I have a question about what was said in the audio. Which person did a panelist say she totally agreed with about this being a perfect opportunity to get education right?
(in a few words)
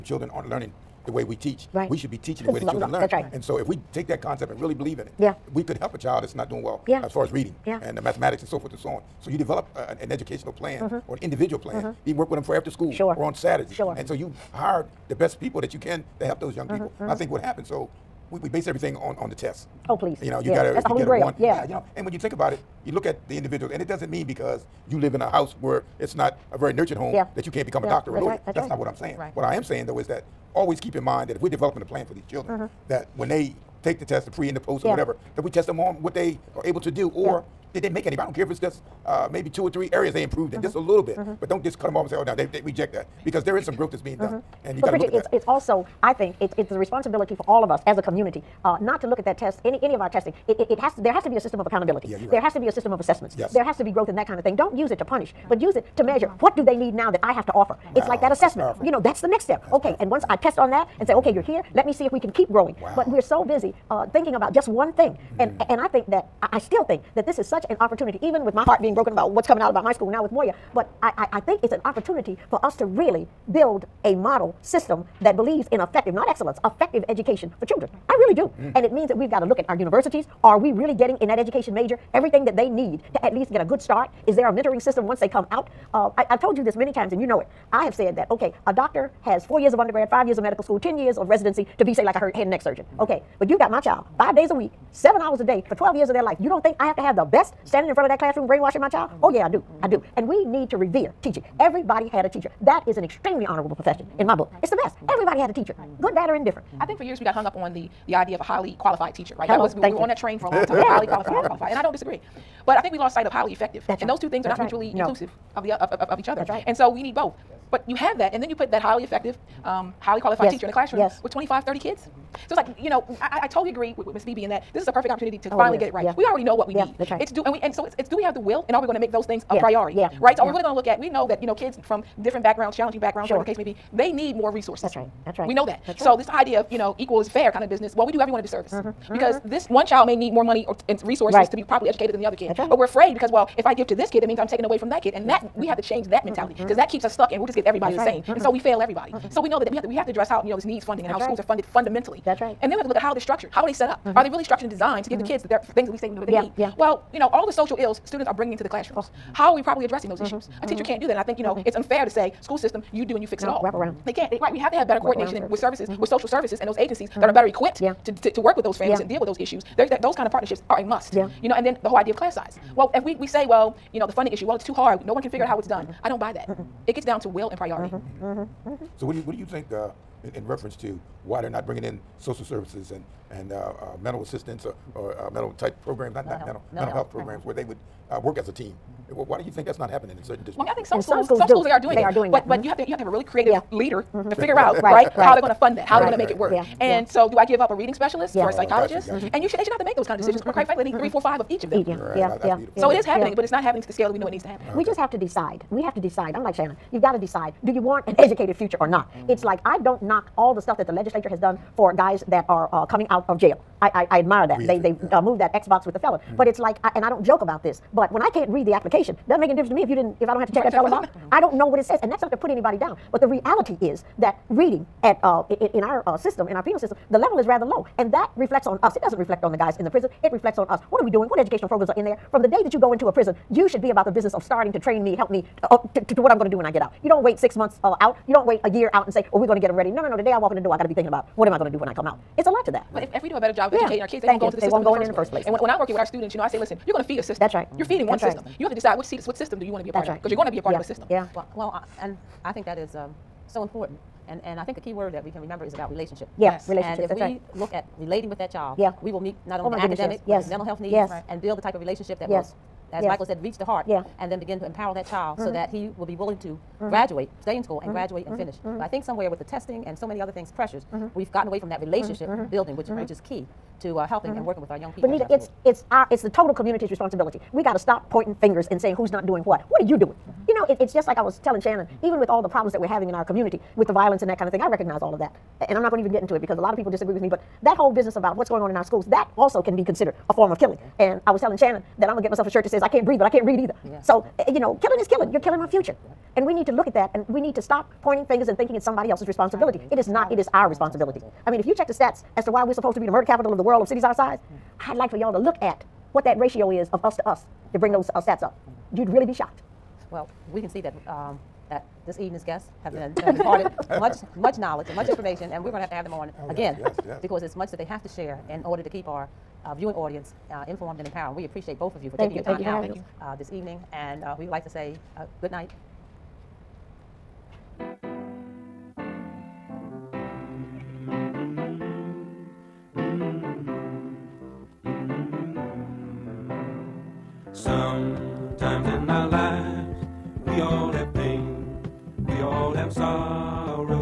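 Ms. Beebe.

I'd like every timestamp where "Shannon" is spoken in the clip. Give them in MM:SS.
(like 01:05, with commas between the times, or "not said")
03:26, 04:41, 04:51.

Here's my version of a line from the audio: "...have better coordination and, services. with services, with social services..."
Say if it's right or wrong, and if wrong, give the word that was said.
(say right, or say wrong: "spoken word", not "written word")
right.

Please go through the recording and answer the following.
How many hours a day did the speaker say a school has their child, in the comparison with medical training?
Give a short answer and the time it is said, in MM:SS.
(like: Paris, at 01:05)
7, at 01:34.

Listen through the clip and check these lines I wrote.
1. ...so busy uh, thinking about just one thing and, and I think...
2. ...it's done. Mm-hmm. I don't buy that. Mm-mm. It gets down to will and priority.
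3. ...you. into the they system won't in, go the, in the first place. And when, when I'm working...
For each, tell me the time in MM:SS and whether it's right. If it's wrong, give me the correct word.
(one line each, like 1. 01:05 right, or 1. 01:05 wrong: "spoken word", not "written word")
1. 01:03 right
2. 02:55 right
3. 04:04 right.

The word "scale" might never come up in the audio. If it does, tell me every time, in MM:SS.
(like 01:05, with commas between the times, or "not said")
03:23.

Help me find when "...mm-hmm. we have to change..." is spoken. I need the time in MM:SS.
02:25.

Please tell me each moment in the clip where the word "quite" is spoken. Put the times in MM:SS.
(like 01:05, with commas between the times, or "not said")
03:20.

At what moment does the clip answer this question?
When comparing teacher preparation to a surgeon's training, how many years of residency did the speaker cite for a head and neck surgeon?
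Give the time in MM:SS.
01:30.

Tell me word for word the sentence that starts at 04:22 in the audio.
will, as Michael said, reach the heart, yeah.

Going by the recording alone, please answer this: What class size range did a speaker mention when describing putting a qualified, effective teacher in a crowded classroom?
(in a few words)
25 to 30 kids.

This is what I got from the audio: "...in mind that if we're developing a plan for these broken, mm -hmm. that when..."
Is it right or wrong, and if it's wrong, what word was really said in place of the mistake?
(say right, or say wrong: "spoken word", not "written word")
wrong: "children", not "broken".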